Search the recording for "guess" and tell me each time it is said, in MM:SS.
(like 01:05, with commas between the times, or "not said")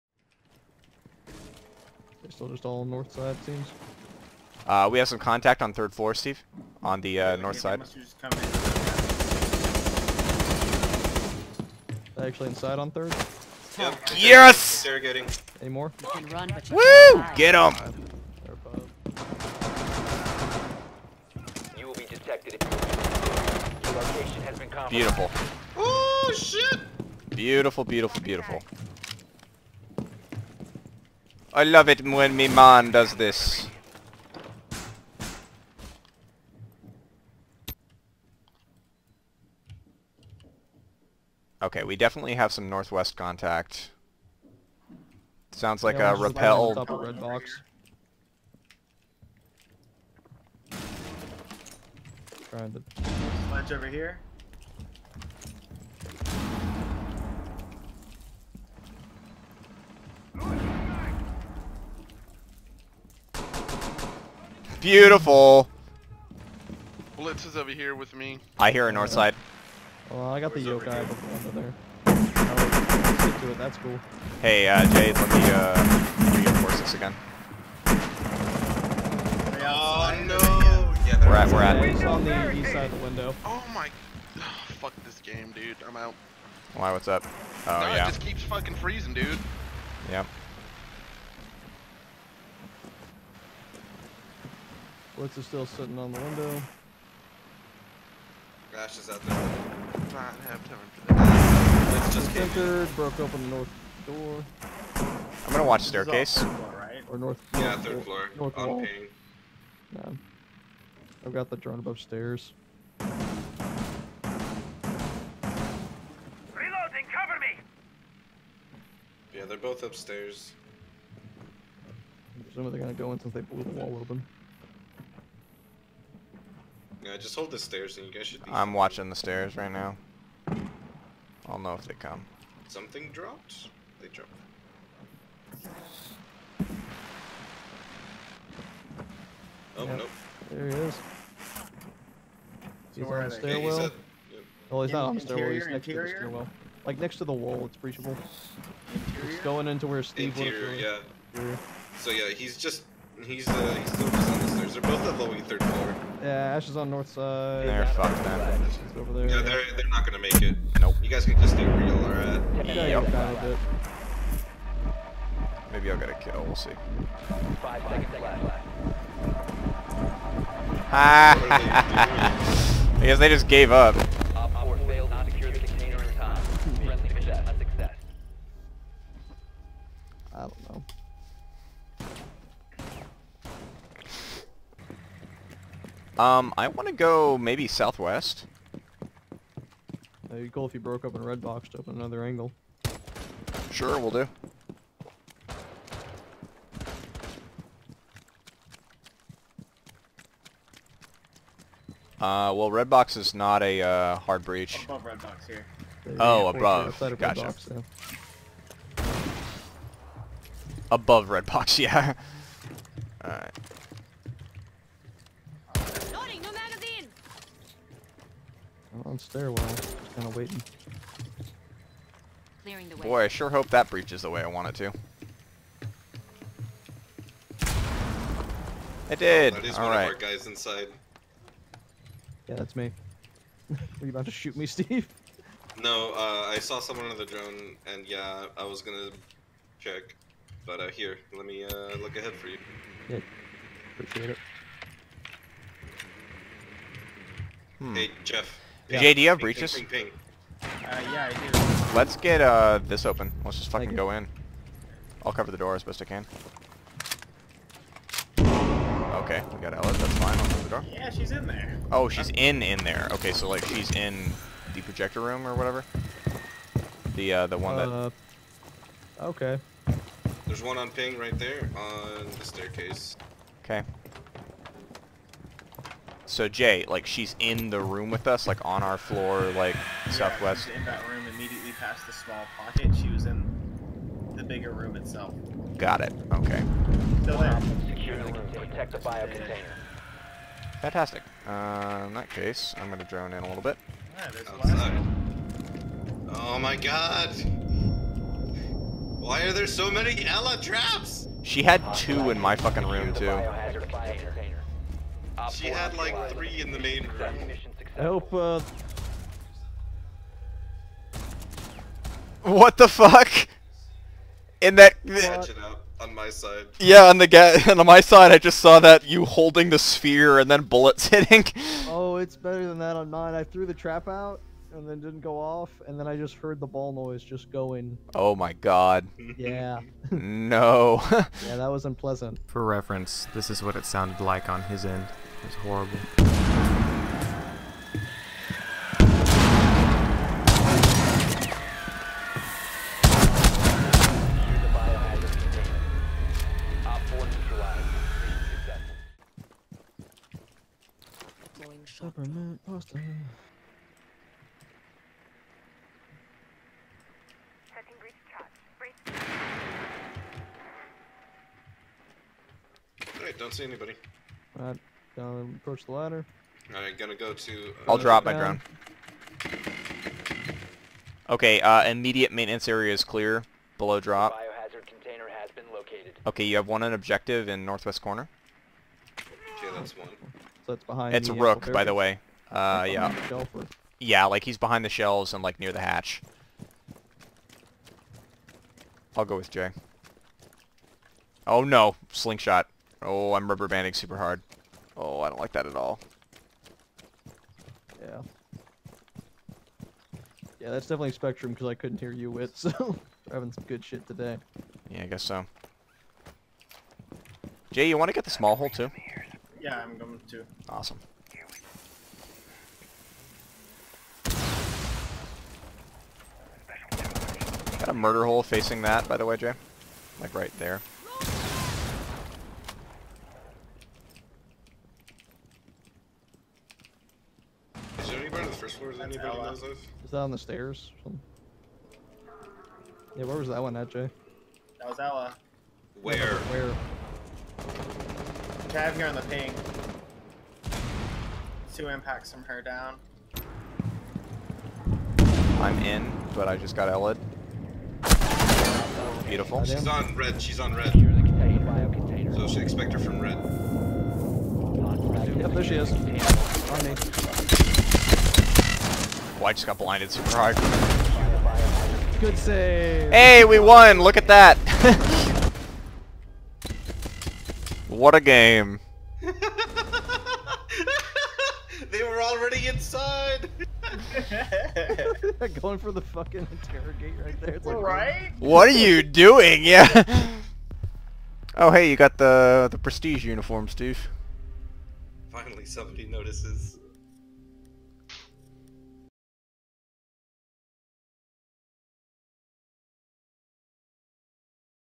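02:53, 06:45.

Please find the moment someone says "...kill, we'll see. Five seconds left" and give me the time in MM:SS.
02:46.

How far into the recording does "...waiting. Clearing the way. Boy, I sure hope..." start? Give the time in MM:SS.
03:40.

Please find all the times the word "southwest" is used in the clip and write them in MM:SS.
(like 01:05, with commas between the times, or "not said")
03:07, 04:40.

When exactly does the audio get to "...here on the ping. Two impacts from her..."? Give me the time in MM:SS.
07:18.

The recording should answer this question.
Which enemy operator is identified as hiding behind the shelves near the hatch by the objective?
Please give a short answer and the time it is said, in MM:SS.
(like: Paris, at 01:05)
Rook, at 06:21.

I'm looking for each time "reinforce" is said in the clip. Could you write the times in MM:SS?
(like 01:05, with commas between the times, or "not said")
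01:16.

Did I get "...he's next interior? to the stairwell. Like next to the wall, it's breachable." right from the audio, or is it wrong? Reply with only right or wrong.
right.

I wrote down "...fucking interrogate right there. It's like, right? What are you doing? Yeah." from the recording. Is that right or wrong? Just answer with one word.
right.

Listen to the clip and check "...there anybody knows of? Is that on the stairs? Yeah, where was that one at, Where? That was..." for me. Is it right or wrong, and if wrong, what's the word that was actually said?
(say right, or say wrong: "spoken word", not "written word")
wrong: "Jay", not "Where".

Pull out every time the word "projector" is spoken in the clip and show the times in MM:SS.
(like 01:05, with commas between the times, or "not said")
04:24.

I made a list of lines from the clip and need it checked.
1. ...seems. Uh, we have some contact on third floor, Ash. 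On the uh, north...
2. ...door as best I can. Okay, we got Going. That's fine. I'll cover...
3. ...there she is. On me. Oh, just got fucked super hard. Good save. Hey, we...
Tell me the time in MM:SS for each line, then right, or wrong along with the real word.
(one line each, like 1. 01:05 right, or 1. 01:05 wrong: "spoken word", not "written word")
1. 00:03 wrong: "Steve", not "Ash"
2. 04:15 wrong: "Ela", not "Going"
3. 07:35 wrong: "blinded", not "fucked".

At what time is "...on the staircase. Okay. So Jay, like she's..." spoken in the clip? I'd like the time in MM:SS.
04:31.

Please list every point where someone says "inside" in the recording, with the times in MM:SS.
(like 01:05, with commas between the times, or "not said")
00:12, 03:50, 07:52.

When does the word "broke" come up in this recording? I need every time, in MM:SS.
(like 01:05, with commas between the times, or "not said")
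01:42, 03:10.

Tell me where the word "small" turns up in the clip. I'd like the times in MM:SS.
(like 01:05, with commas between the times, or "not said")
04:42, 06:48.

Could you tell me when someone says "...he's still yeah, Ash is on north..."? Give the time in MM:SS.
02:33.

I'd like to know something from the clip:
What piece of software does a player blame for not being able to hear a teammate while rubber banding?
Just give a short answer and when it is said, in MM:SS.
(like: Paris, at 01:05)
Spectrum, at 06:41.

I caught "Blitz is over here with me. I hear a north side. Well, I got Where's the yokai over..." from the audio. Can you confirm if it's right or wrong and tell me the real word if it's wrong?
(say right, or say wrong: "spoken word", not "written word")
right.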